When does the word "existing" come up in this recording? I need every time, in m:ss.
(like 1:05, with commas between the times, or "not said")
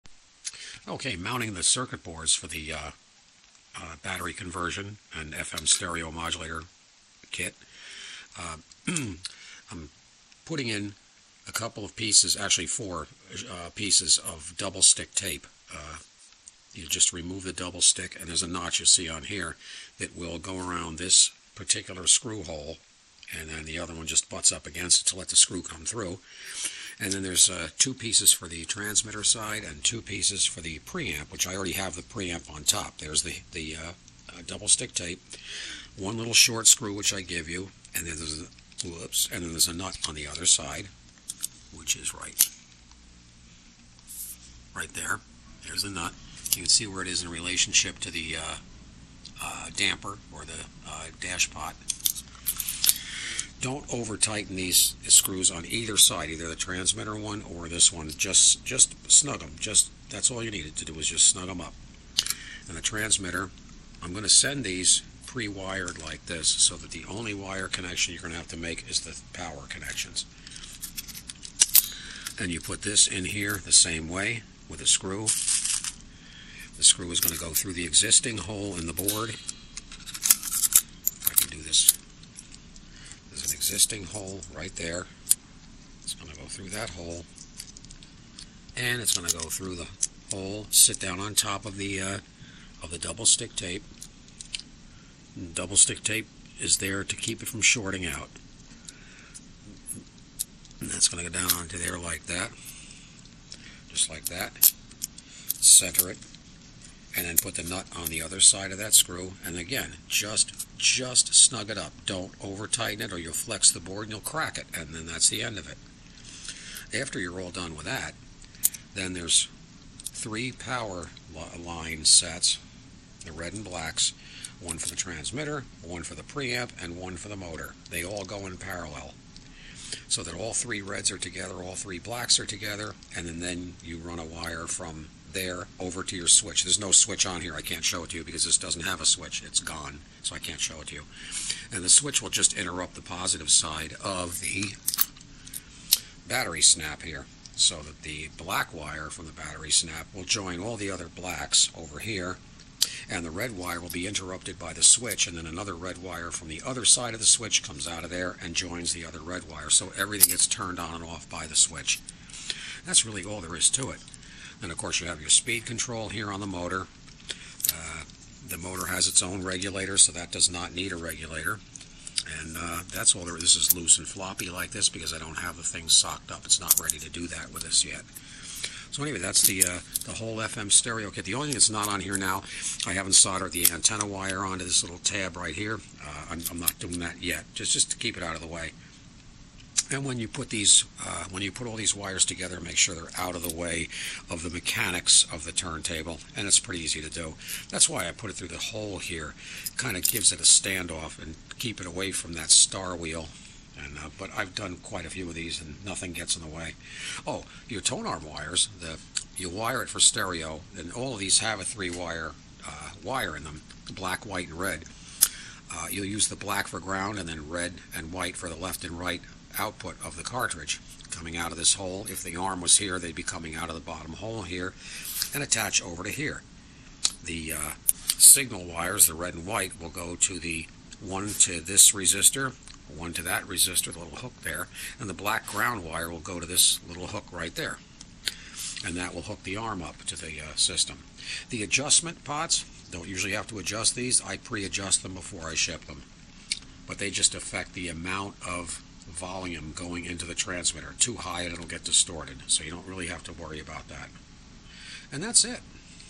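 1:17, 1:23.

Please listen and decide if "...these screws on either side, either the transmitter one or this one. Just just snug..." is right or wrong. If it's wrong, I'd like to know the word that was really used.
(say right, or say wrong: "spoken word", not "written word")
right.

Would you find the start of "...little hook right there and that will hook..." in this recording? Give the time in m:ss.
3:56.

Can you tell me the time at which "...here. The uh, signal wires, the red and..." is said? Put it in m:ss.
3:46.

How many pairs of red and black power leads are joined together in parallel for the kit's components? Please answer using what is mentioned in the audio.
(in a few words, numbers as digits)
3.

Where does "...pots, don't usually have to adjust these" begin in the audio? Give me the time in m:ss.
4:02.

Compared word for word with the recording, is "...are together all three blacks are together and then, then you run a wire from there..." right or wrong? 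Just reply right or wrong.
right.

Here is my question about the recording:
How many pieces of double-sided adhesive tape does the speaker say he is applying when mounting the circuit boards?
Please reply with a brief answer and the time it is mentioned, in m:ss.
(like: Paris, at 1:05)
4, at 0:12.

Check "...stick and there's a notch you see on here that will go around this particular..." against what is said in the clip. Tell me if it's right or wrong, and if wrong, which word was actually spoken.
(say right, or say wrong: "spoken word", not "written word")
right.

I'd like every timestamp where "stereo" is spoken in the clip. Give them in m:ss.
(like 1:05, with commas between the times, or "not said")
0:05, 3:00, 3:29.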